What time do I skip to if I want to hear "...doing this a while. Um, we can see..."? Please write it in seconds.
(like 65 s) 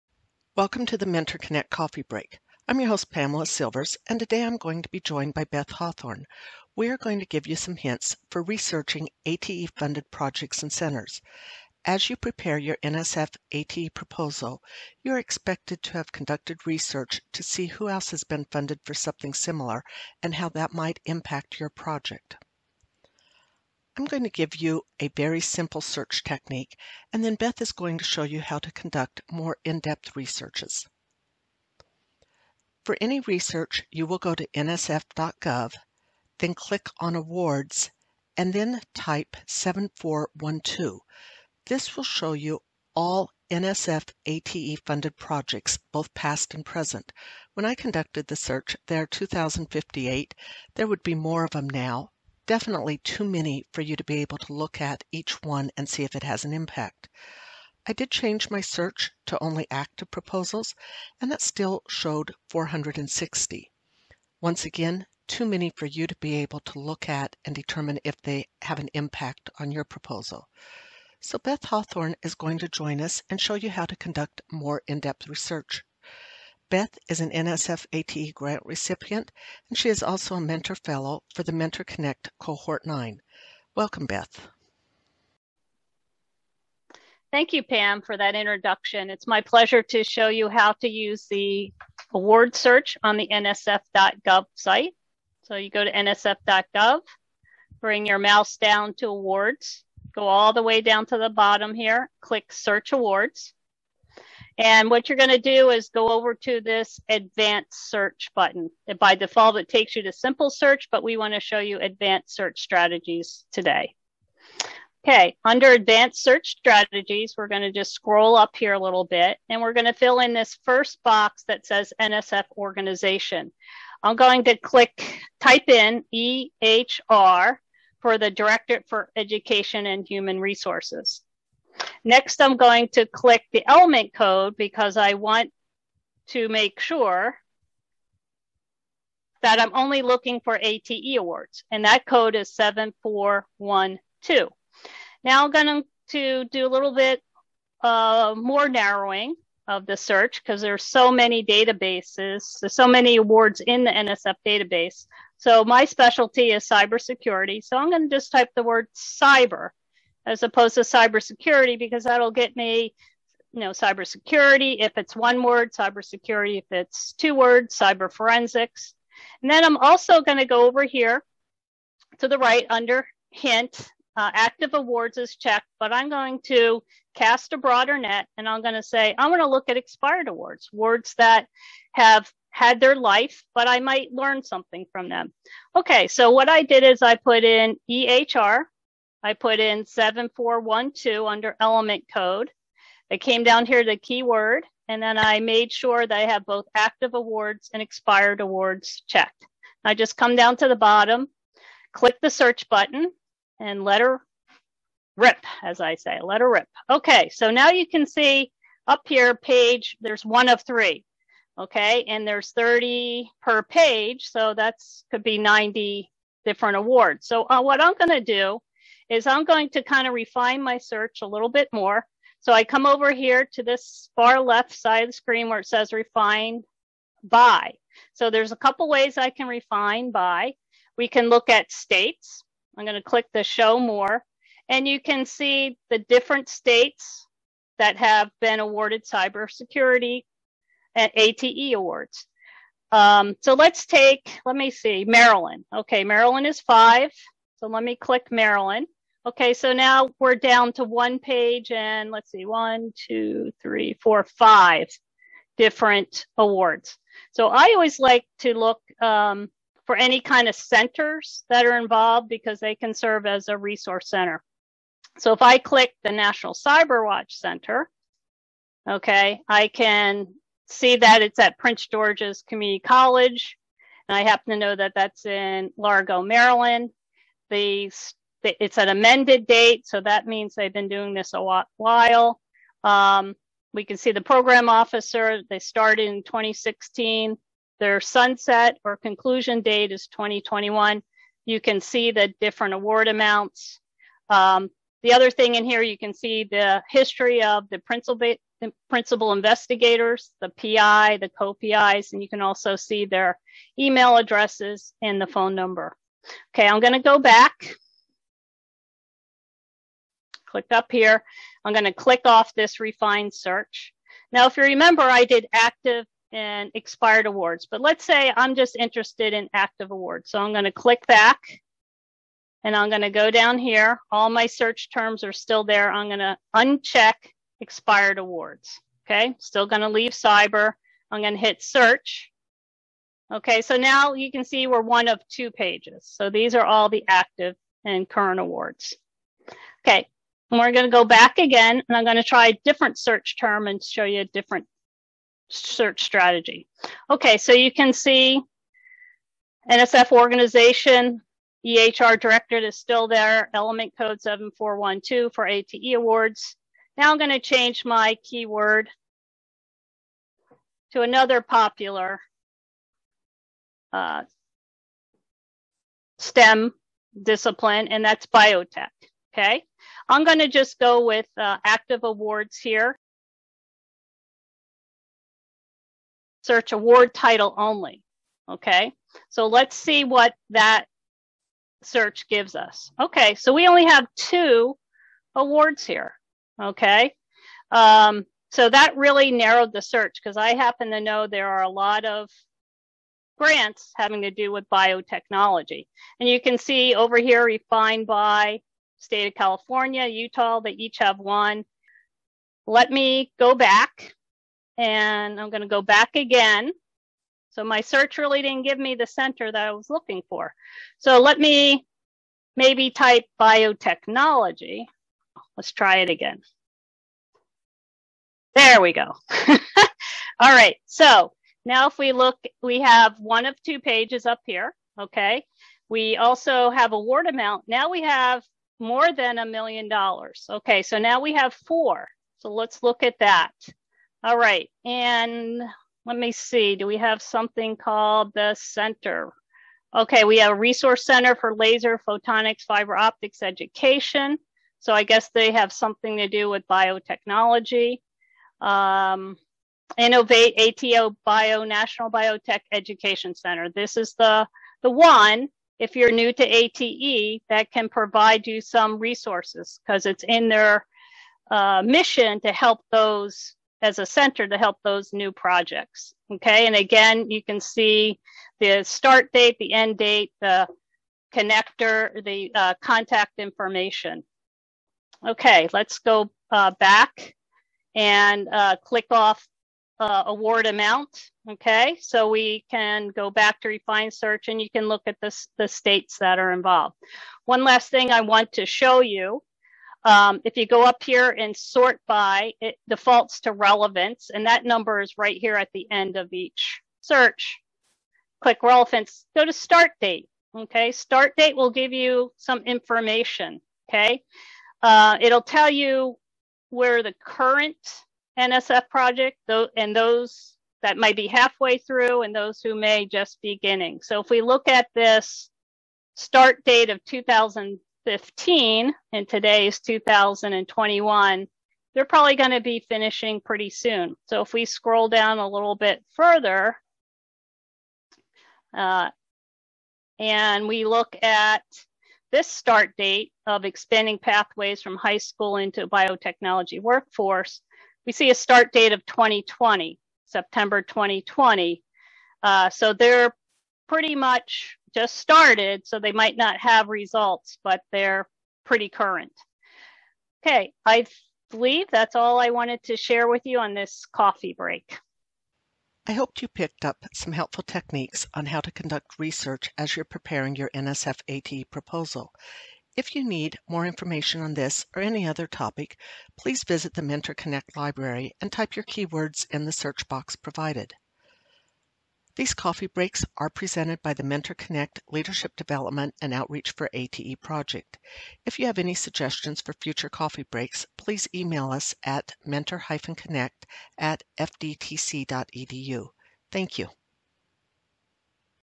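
280 s.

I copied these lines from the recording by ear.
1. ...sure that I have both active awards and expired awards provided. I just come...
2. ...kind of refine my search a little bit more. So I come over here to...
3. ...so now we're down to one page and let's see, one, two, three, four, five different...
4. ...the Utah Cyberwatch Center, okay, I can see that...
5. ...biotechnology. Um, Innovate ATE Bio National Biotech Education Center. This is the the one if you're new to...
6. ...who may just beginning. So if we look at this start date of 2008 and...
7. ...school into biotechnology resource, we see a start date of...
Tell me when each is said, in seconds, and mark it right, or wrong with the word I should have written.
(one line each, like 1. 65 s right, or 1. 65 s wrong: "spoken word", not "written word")
1. 195 s wrong: "checked", not "provided"
2. 219 s right
3. 249 s right
4. 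266 s wrong: "National", not "Utah"
5. 446 s right
6. 512 s wrong: "2015", not "2008"
7. 535 s wrong: "workforce", not "resource".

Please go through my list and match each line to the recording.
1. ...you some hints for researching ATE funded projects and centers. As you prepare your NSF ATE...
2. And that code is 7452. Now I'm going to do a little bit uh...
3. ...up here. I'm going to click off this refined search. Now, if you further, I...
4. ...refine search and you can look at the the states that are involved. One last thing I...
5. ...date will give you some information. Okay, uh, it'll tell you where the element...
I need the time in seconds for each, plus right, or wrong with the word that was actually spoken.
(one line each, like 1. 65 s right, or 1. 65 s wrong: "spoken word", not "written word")
1. 7 s right
2. 141 s wrong: "7412", not "7452"
3. 310 s wrong: "remember", not "further"
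4. 483 s right
5. 501 s wrong: "current", not "element".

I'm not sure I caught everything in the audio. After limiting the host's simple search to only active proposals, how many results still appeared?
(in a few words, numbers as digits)
460.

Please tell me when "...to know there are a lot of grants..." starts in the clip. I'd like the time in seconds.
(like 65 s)
390 s.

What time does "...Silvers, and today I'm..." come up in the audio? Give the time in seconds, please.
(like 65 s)
3 s.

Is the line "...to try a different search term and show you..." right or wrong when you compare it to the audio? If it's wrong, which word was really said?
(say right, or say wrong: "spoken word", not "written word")
right.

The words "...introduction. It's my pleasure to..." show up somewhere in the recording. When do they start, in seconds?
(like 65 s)
88 s.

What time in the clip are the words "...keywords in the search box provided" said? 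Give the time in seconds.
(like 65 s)
568 s.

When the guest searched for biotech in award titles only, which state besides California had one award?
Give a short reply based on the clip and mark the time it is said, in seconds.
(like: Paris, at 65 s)
Utah, at 400 s.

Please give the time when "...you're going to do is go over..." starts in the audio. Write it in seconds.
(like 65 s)
105 s.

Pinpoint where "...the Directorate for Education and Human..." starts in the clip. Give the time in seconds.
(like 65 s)
128 s.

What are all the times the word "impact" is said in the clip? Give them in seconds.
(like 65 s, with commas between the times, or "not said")
21 s, 56 s, 68 s.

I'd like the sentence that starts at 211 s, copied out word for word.
Okay, and there's 30 per page, so that's could be 90 different awards.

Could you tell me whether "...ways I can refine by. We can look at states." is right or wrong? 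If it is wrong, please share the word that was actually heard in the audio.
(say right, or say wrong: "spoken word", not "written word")
right.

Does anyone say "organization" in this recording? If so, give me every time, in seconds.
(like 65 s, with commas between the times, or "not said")
122 s, 350 s.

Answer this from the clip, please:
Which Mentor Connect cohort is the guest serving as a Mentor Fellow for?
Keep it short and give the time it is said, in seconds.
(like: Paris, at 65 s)
Cohort 9, at 82 s.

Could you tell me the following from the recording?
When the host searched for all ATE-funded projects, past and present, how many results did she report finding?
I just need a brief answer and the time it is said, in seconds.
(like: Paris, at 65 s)
2,058, at 49 s.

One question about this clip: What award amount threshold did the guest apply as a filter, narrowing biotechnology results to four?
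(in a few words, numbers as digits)
More than $1 million.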